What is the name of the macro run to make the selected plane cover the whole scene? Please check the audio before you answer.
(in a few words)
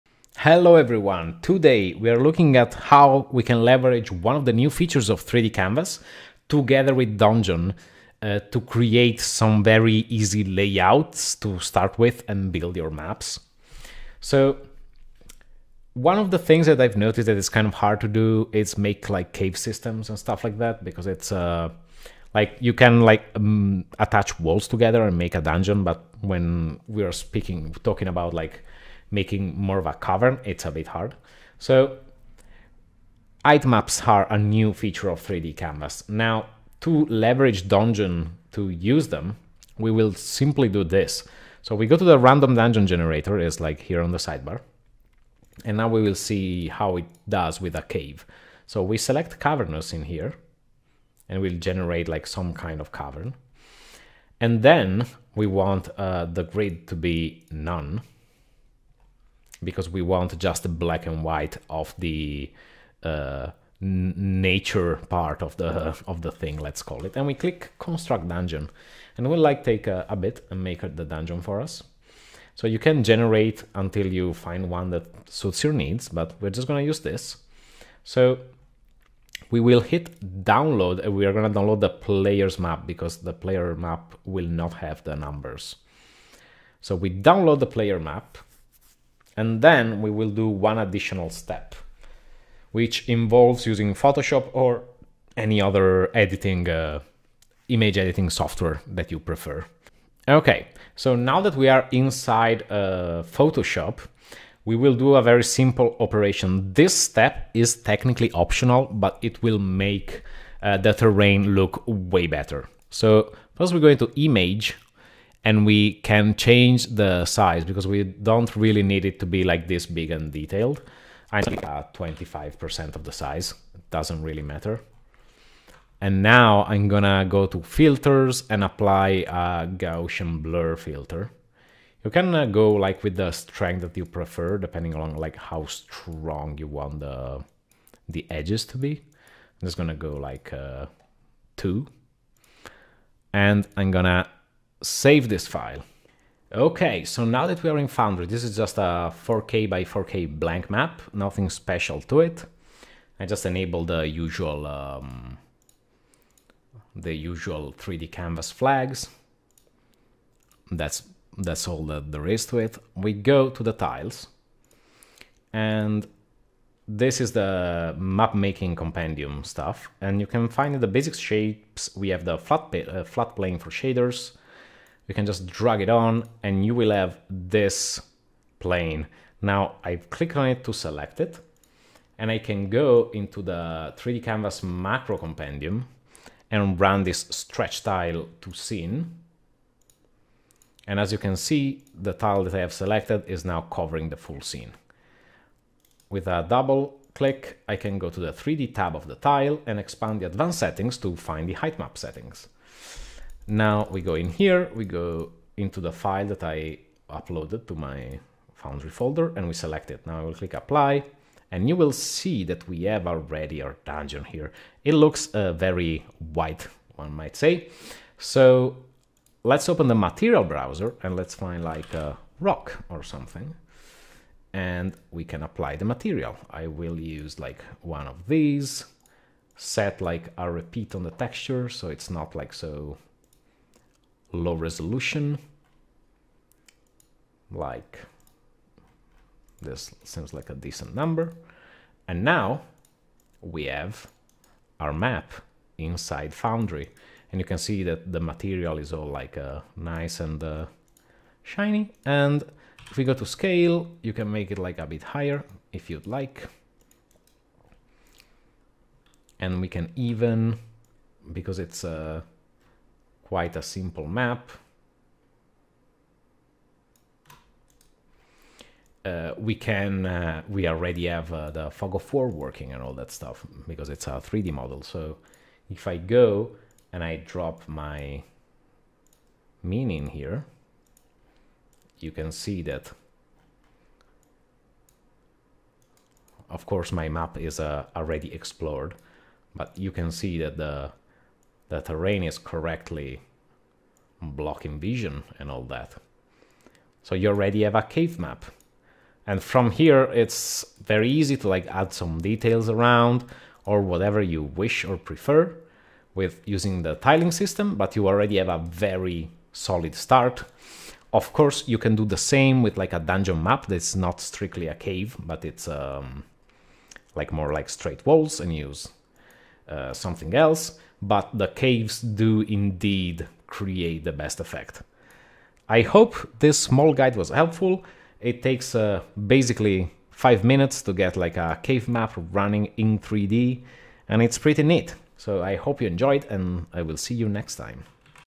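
Stretch tile to scene.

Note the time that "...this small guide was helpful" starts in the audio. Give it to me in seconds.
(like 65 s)
326 s.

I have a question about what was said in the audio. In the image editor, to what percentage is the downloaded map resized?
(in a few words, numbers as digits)
25%.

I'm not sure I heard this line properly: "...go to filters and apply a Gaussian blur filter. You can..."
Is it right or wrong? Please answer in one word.
right.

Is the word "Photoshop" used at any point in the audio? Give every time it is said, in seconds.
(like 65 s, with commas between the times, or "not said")
93 s, 103 s.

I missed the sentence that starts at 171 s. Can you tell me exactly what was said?
We have the flat uh, flat plane for shaders, you can just drag it on and you will have this plane.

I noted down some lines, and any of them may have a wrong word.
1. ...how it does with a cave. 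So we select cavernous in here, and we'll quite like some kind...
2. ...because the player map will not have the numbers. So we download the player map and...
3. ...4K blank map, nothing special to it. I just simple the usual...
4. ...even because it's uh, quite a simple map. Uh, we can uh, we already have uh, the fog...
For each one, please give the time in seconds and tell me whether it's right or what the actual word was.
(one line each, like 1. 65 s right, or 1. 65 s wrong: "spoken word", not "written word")
1. 46 s wrong: "generate", not "quite"
2. 82 s right
3. 149 s wrong: "enable", not "simple"
4. 259 s right.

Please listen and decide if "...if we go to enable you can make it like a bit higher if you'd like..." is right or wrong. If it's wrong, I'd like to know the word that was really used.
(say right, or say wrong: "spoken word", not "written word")
wrong: "scale", not "enable".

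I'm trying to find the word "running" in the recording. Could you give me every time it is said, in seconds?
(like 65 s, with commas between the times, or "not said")
332 s.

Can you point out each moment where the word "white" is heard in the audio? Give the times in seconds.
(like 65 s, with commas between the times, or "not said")
61 s, 216 s.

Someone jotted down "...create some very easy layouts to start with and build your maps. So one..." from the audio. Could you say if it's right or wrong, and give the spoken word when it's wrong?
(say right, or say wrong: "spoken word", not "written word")
right.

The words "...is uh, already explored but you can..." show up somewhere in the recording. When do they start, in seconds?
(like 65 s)
287 s.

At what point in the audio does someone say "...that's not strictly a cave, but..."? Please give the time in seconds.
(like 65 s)
313 s.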